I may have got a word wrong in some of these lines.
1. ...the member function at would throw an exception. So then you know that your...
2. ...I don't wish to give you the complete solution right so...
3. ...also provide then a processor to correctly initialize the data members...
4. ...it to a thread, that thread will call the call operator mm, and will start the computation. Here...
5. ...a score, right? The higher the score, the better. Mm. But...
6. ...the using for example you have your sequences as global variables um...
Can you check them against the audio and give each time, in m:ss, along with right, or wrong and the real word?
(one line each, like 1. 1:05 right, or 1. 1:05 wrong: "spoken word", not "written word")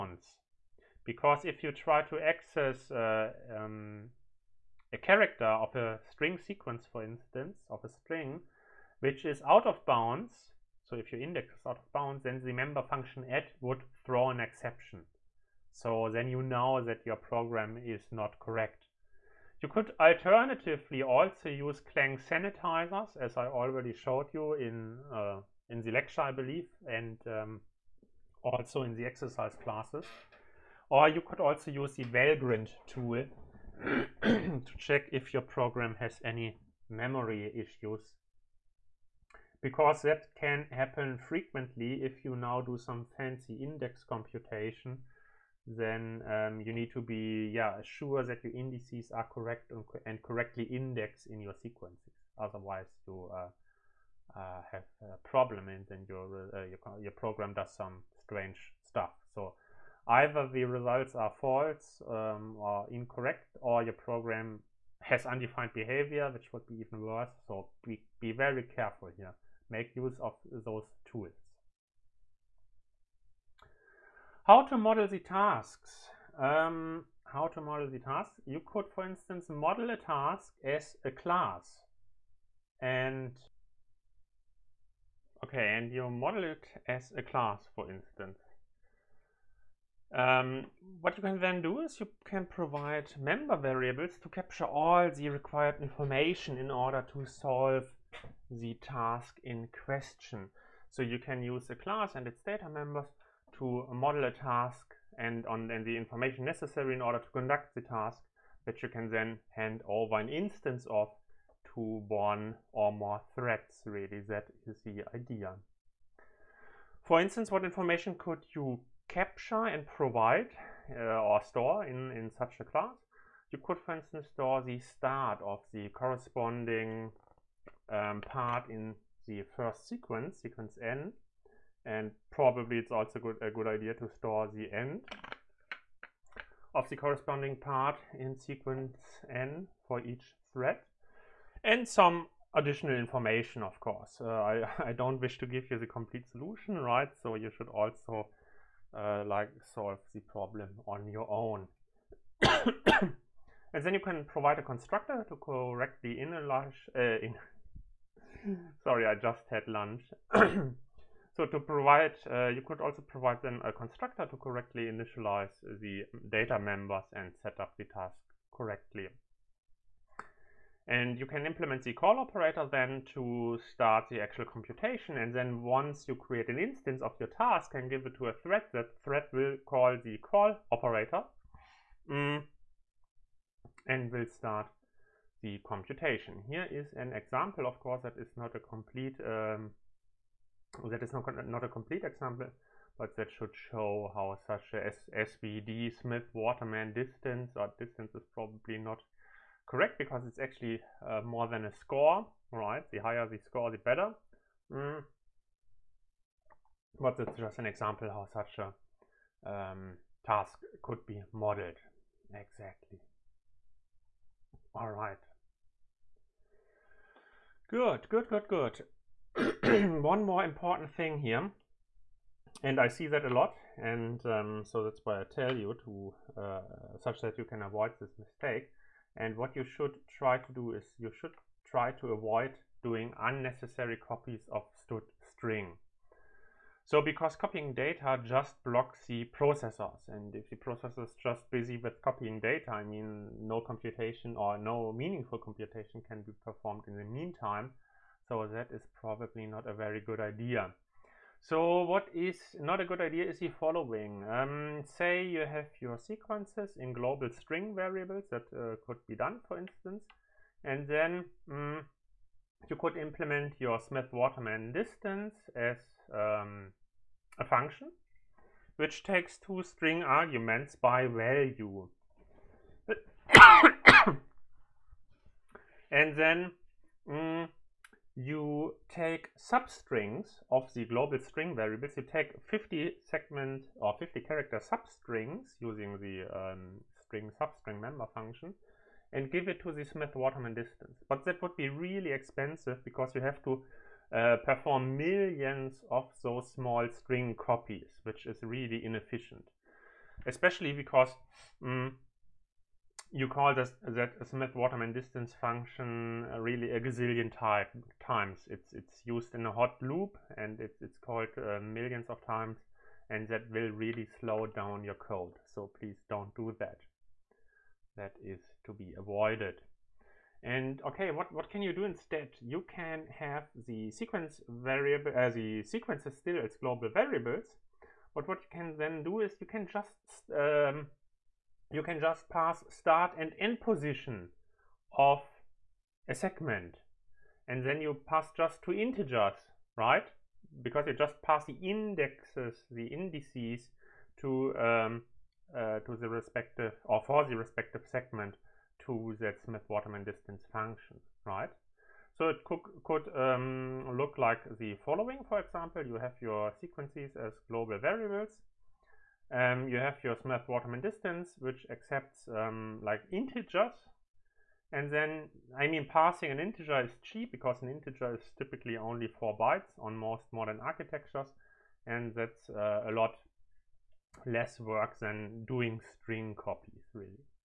1. 0:12 right
2. 2:24 right
3. 2:42 wrong: "constructor", not "processor"
4. 2:58 right
5. 3:21 right
6. 5:54 wrong: "following", not "using".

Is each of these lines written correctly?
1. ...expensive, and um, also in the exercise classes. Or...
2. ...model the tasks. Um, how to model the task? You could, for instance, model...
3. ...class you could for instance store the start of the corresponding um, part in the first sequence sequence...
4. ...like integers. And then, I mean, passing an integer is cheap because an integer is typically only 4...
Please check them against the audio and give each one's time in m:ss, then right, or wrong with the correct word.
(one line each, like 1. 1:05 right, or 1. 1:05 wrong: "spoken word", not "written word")
1. 0:26 wrong: "believe", not "expensive"
2. 1:14 right
3. 2:02 right
4. 6:02 right.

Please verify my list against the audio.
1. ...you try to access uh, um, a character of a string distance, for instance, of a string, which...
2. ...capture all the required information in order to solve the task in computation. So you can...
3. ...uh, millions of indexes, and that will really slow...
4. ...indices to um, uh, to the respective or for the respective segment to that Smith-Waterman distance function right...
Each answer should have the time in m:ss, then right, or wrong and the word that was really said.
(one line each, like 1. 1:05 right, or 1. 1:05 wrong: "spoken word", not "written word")
1. 0:01 wrong: "sequence", not "distance"
2. 1:34 wrong: "question", not "computation"
3. 5:11 wrong: "times", not "indexes"
4. 5:42 right.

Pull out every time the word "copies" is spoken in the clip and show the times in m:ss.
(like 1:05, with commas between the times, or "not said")
3:53, 4:57, 6:16.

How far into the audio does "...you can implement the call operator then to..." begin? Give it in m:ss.
2:51.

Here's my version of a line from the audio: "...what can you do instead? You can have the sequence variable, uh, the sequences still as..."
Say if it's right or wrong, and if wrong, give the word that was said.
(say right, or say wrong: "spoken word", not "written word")
right.